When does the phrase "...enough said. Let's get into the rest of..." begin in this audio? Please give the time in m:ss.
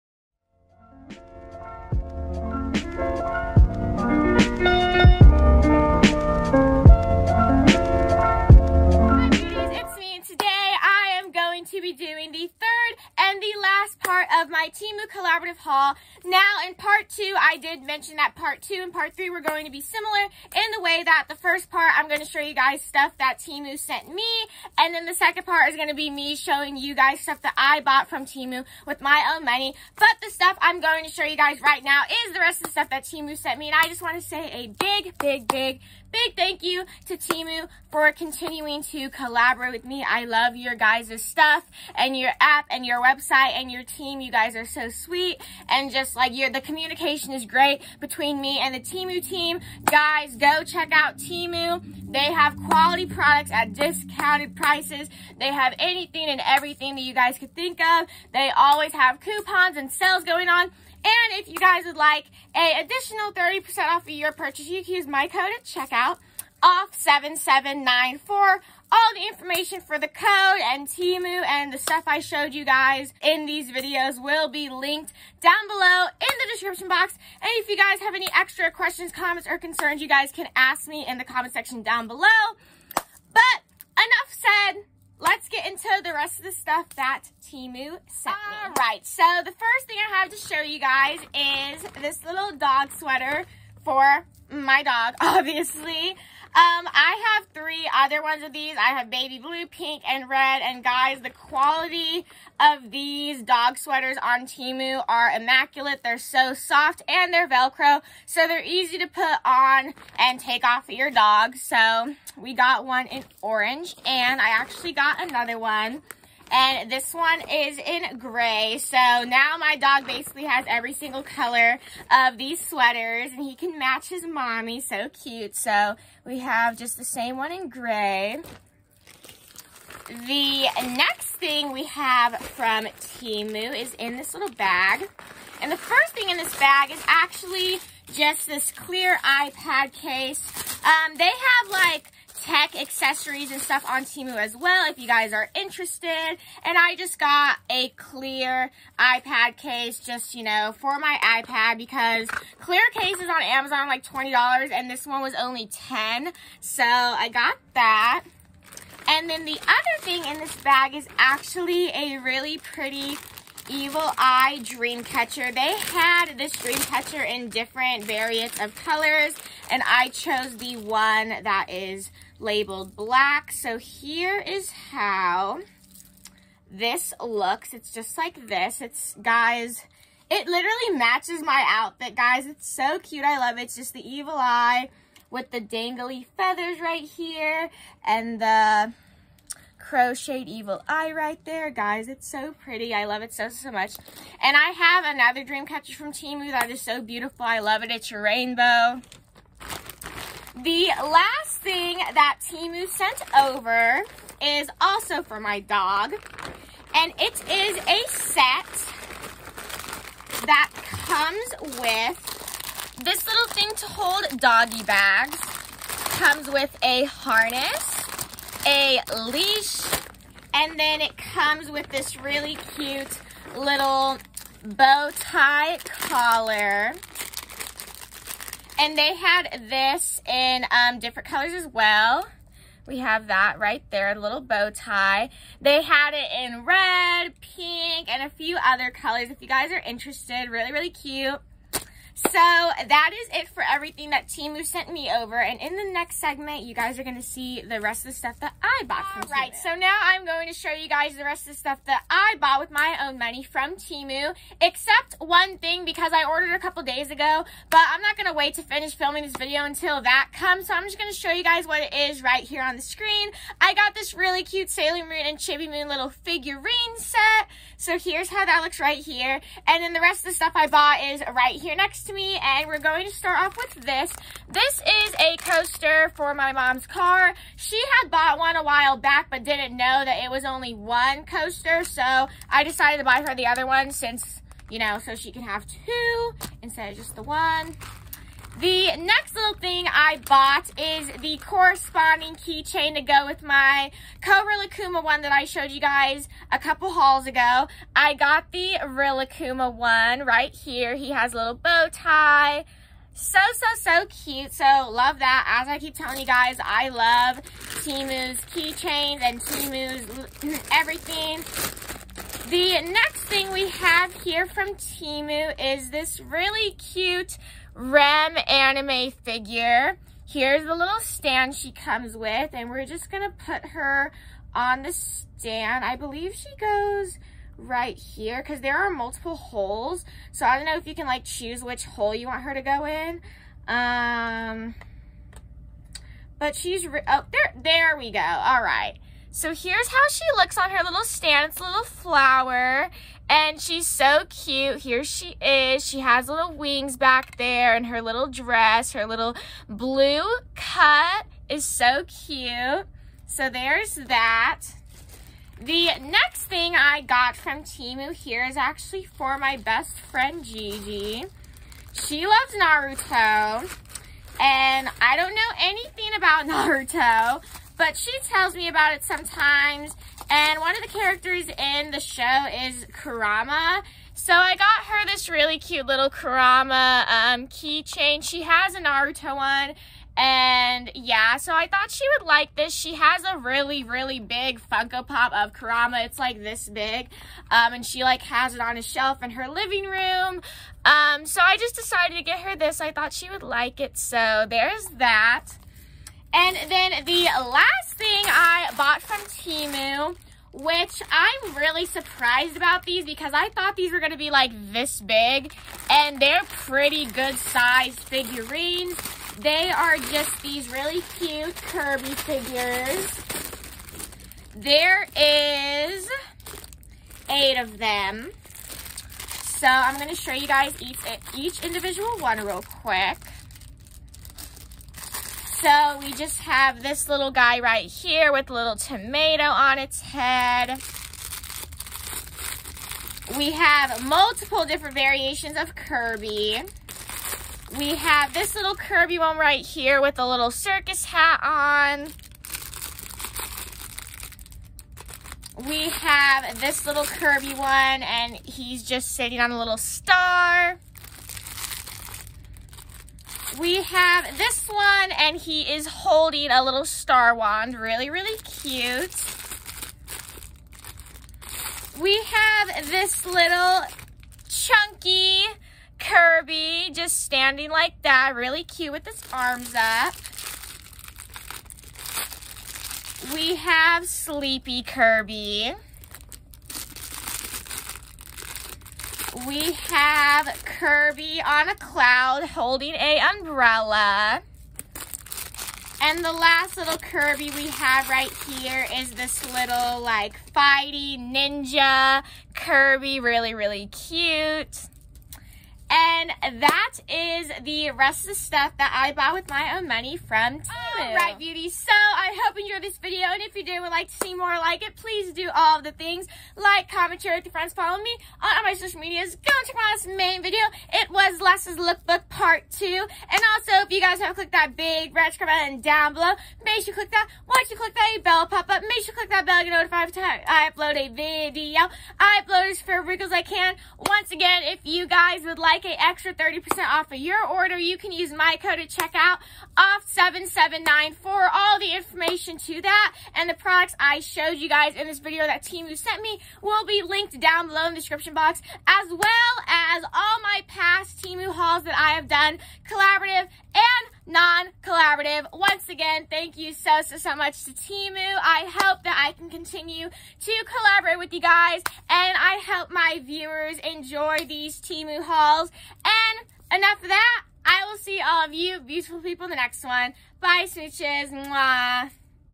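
1:23.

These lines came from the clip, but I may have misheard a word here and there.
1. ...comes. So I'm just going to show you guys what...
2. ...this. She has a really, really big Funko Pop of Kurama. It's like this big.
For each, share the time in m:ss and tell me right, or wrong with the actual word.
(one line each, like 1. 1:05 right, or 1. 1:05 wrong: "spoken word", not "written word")
1. 4:20 right
2. 6:22 right.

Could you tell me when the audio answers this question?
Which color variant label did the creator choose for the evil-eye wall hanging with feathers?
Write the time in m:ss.
2:52.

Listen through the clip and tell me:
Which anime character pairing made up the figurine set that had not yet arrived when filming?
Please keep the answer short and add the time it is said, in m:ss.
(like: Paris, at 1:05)
Sailor Moon and Chibi Moon, at 4:24.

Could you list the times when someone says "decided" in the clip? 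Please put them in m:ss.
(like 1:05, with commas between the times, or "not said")
4:42, 6:31.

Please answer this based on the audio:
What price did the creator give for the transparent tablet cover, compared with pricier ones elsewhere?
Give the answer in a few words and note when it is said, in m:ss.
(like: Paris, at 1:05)
10, at 2:34.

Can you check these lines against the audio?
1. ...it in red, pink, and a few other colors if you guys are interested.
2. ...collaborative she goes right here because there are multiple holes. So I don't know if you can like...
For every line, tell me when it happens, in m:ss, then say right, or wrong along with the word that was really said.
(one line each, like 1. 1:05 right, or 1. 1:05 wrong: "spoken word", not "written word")
1. 3:56 right
2. 5:25 wrong: "believe", not "collaborative".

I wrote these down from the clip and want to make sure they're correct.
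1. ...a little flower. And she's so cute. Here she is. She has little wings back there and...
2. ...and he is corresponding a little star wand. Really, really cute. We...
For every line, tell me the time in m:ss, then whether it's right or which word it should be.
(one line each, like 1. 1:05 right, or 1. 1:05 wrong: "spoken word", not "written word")
1. 5:41 right
2. 7:35 wrong: "holding", not "corresponding".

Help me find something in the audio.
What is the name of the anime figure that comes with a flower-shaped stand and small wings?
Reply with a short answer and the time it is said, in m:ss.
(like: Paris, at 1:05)
Rem, at 5:17.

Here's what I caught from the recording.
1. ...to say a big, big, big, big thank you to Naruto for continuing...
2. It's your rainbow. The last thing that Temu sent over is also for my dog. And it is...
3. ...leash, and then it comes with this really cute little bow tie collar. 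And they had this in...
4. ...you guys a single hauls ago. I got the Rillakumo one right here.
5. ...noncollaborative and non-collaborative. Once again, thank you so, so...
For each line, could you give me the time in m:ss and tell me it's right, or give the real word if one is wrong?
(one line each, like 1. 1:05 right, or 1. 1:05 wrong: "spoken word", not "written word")
1. 0:34 wrong: "Temu", not "Naruto"
2. 3:17 right
3. 3:39 right
4. 4:55 wrong: "couple", not "single"
5. 9:02 wrong: "collaborative", not "noncollaborative".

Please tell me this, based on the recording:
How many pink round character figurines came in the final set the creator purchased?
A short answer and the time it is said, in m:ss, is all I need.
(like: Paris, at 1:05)
8, at 6:57.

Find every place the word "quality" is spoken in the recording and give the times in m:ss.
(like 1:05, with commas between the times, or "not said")
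0:52, 1:41.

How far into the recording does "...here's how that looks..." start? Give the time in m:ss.
4:27.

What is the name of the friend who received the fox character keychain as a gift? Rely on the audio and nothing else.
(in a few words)
Gigi.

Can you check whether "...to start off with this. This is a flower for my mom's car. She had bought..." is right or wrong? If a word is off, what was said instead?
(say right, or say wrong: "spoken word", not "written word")
wrong: "coaster", not "flower".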